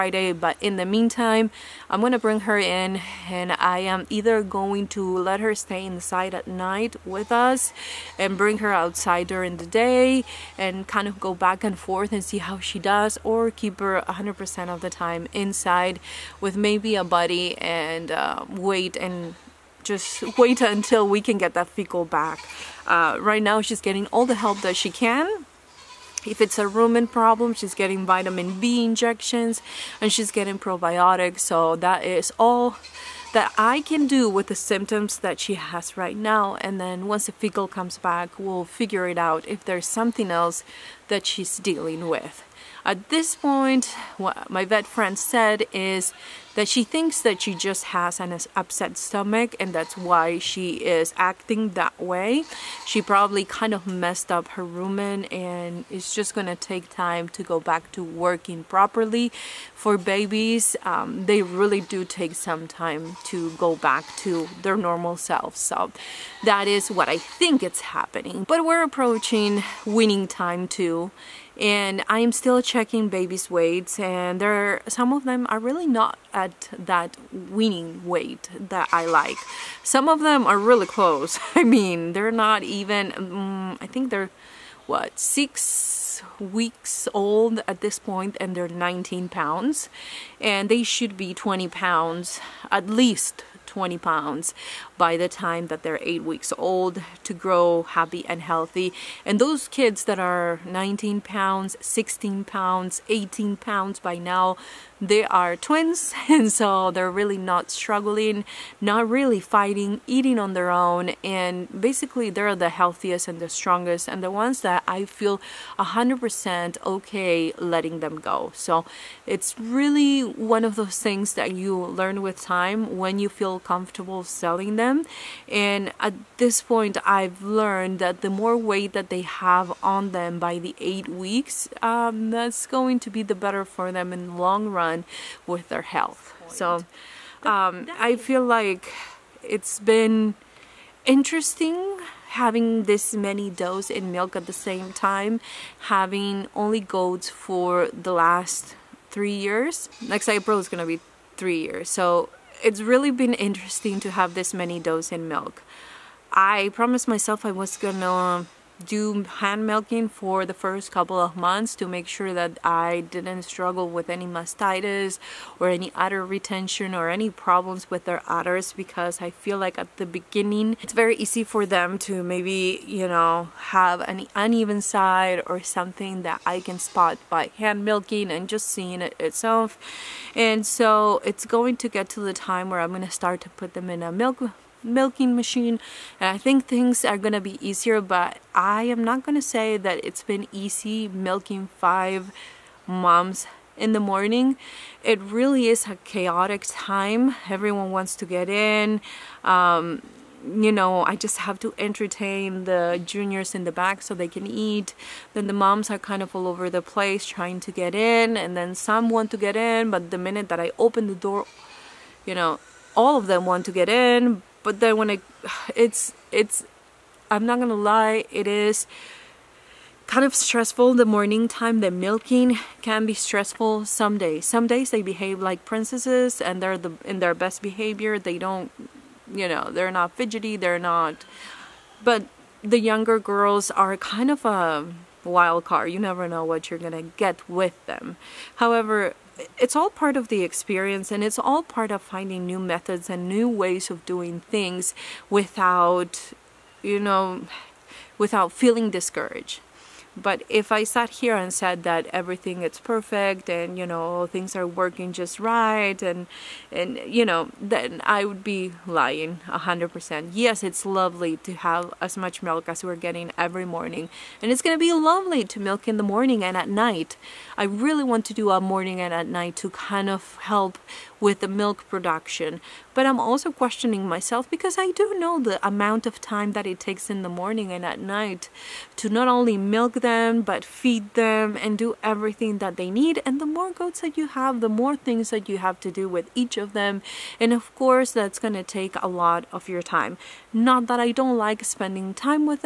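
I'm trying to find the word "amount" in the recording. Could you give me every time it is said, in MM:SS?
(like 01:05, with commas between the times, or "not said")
04:35.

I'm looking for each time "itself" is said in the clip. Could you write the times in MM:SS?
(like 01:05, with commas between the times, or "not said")
02:59.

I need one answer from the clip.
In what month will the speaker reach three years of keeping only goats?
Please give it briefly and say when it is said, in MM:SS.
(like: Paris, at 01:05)
April, at 02:30.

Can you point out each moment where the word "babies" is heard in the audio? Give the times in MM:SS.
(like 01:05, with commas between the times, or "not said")
00:59, 01:13.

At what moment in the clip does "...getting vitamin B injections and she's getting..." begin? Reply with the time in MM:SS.
00:27.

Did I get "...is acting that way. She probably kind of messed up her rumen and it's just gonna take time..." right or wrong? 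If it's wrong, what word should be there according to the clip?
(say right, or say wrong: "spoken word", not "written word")
right.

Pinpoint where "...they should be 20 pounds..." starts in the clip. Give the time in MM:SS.
01:30.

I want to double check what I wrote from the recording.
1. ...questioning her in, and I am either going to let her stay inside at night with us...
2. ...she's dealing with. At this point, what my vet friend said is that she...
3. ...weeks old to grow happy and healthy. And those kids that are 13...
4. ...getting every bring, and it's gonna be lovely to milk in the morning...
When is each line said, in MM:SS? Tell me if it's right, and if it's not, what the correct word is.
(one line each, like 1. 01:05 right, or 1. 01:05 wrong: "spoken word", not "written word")
1. 00:02 wrong: "bring", not "questioning"
2. 00:41 right
3. 01:36 wrong: "19", not "13"
4. 04:22 wrong: "morning", not "bring".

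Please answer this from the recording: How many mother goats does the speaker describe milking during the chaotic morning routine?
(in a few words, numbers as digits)
5.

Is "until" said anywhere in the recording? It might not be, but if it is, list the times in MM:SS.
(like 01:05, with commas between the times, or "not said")
00:20.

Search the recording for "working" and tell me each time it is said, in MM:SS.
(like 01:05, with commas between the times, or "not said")
00:58, 04:14.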